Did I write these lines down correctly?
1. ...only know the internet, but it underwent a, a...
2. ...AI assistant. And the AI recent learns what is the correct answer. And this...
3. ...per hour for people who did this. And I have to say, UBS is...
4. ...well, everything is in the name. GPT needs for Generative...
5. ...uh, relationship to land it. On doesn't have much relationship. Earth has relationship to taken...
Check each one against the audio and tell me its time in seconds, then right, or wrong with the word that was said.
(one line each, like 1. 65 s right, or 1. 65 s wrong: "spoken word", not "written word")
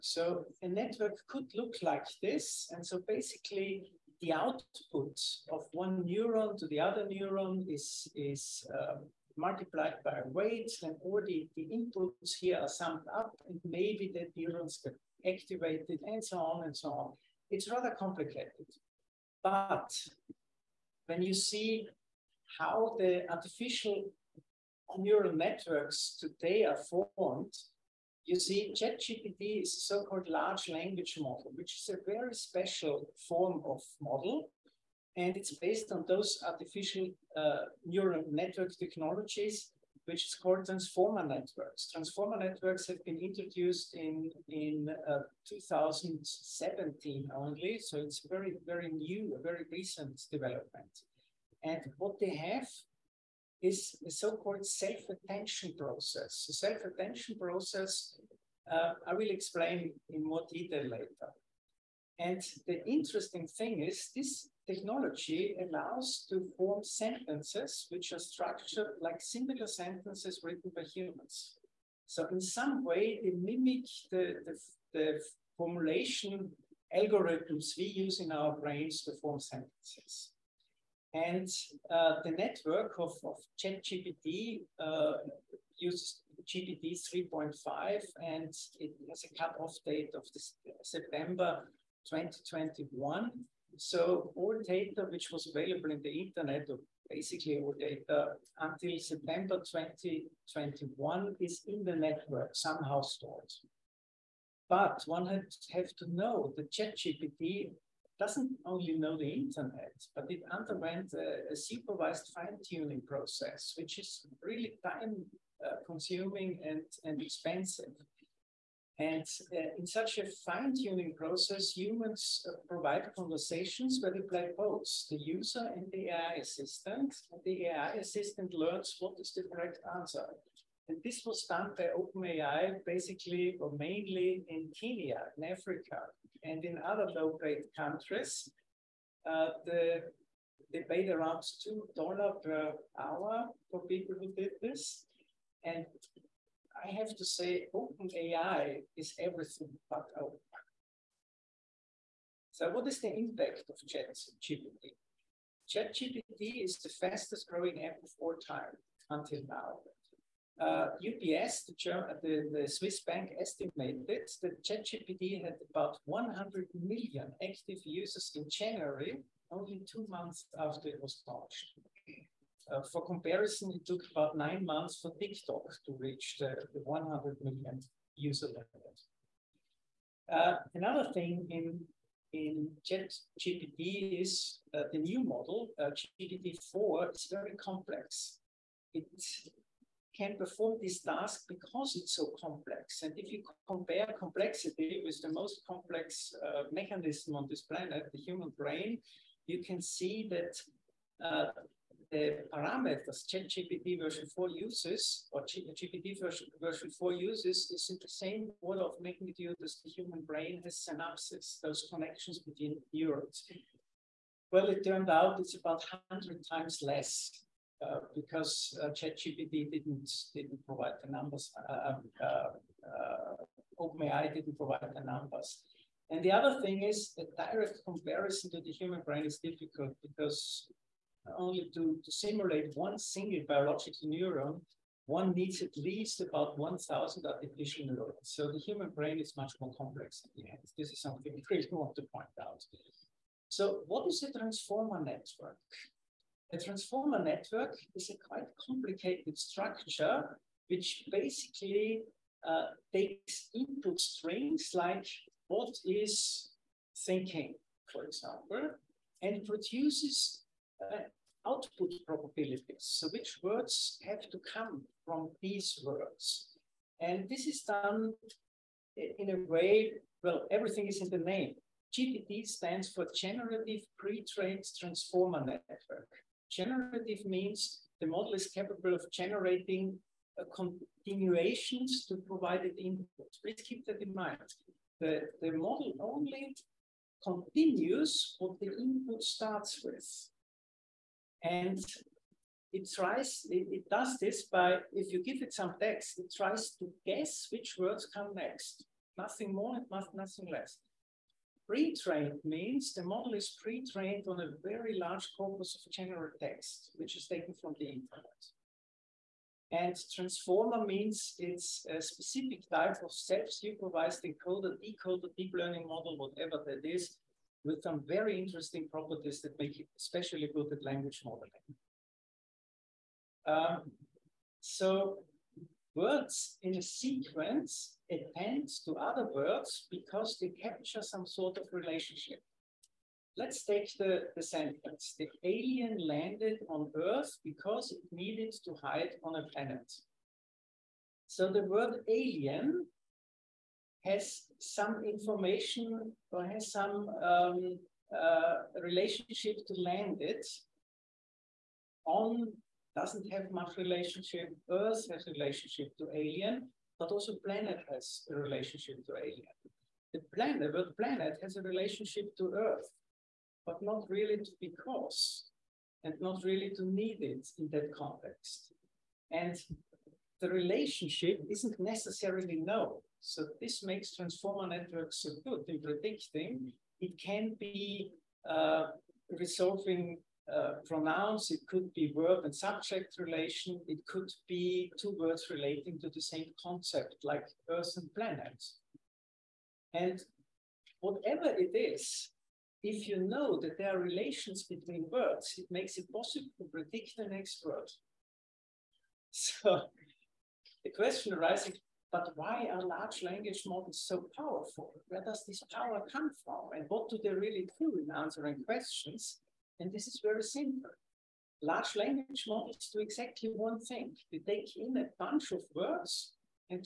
1. 108 s right
2. 126 s wrong: "assistant", not "recent"
3. 142 s wrong: "OpenAI", not "UBS"
4. 270 s wrong: "stands", not "needs"
5. 348 s wrong: "alien", not "taken".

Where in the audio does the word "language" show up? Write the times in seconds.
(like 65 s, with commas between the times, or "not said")
30 s, 320 s, 403 s, 411 s.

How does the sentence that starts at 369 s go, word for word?
And the relationship isn't necessarily known.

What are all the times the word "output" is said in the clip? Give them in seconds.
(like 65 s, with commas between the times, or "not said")
4 s, 261 s.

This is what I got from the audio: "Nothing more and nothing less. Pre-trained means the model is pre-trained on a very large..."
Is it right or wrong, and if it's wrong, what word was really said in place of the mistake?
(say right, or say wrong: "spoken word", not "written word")
right.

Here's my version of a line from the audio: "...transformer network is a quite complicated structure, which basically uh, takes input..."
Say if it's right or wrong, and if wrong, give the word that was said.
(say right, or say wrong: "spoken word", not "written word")
right.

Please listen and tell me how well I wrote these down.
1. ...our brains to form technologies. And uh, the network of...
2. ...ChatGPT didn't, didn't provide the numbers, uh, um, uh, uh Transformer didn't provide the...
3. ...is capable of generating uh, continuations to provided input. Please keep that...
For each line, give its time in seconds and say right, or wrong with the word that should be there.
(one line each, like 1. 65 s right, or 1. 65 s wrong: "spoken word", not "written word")
1. 78 s wrong: "sentences", not "technologies"
2. 218 s wrong: "OpenAI", not "Transformer"
3. 278 s right.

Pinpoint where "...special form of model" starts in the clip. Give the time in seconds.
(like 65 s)
32 s.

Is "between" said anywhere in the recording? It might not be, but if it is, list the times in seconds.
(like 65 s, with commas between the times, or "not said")
212 s, 394 s.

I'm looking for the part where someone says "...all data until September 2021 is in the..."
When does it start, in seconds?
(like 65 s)
97 s.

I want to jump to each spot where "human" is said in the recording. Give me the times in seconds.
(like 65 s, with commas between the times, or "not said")
70 s, 121 s, 198 s, 209 s, 228 s, 238 s.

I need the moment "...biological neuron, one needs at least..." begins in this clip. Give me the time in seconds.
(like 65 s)
233 s.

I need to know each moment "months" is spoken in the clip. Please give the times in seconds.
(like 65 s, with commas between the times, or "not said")
170 s, 174 s.